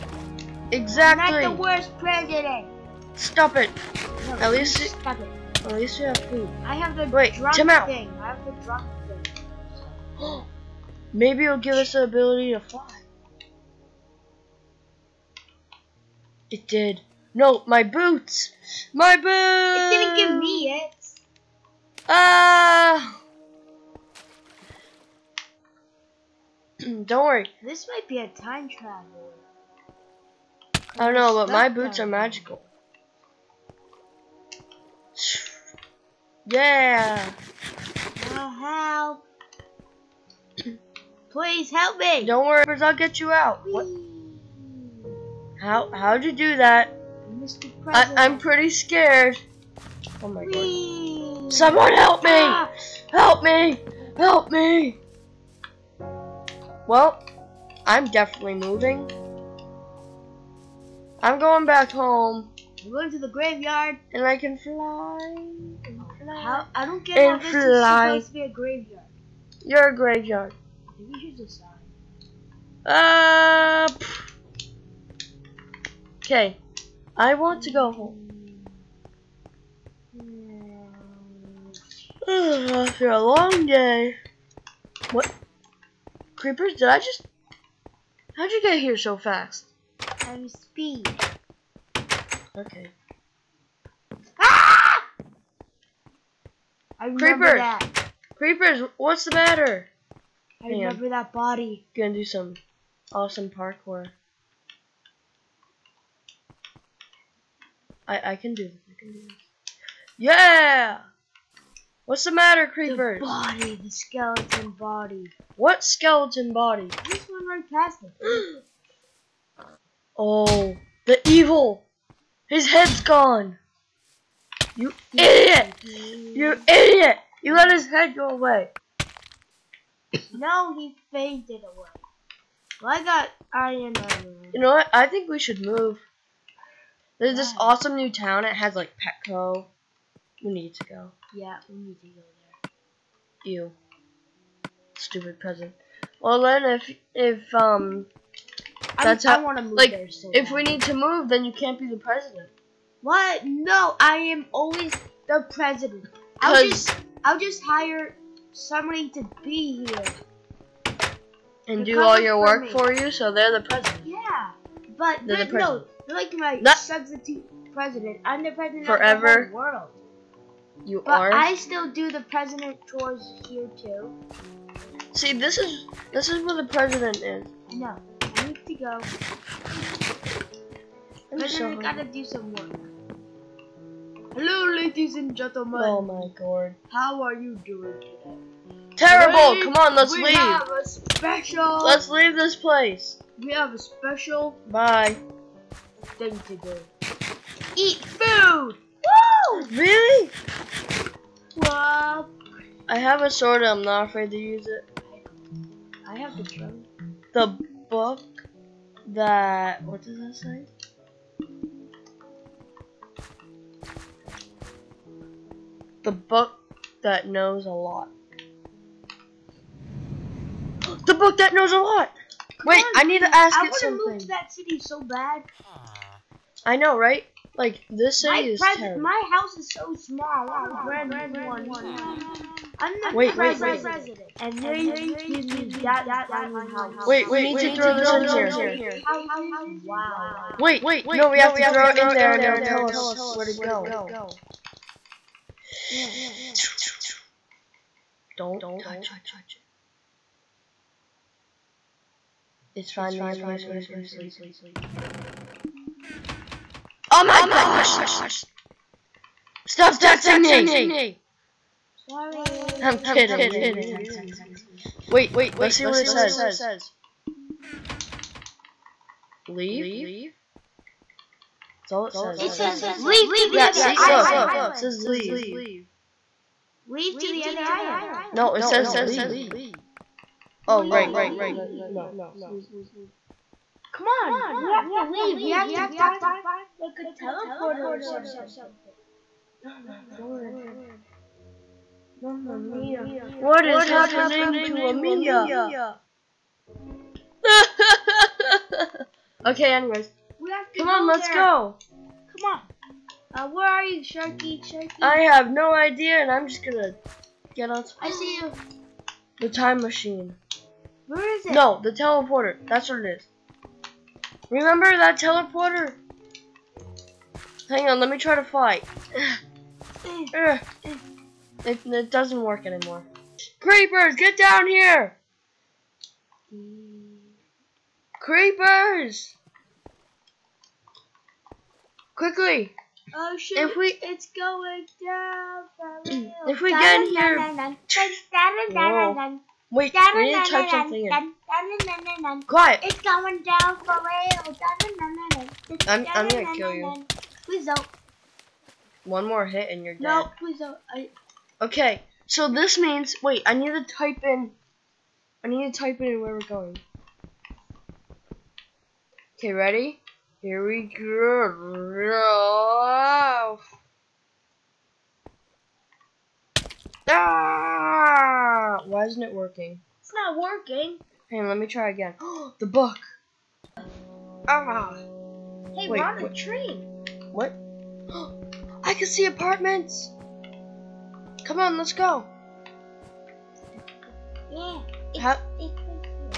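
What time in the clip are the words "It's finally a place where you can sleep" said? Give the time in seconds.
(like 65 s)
252 s.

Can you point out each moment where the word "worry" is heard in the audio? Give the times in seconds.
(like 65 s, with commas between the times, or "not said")
27 s, 42 s.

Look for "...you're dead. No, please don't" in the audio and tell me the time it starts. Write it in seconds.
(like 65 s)
349 s.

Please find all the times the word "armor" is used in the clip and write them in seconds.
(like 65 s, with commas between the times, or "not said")
133 s.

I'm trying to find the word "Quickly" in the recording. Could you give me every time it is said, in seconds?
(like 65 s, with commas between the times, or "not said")
332 s.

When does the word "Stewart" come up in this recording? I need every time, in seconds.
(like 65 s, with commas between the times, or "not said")
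not said.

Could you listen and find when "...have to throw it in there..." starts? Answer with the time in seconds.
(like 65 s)
241 s.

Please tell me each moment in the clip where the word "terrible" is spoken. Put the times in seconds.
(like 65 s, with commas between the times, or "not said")
188 s, 228 s.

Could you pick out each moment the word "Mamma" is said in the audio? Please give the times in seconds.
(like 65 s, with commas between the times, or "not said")
292 s.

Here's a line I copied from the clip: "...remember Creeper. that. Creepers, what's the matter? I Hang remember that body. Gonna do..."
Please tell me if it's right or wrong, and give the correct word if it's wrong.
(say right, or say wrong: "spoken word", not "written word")
right.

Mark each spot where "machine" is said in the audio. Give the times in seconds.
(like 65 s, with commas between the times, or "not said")
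309 s.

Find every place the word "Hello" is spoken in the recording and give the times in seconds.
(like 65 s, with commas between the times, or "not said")
184 s.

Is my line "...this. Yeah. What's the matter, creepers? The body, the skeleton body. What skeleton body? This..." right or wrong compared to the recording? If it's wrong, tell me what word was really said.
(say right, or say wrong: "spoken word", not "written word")
right.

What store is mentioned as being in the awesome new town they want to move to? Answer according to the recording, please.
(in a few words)
Petco.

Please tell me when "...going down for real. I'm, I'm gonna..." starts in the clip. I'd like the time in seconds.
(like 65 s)
343 s.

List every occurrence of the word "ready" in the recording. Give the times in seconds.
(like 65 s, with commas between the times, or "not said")
359 s.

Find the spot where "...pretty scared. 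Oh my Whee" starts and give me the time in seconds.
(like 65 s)
48 s.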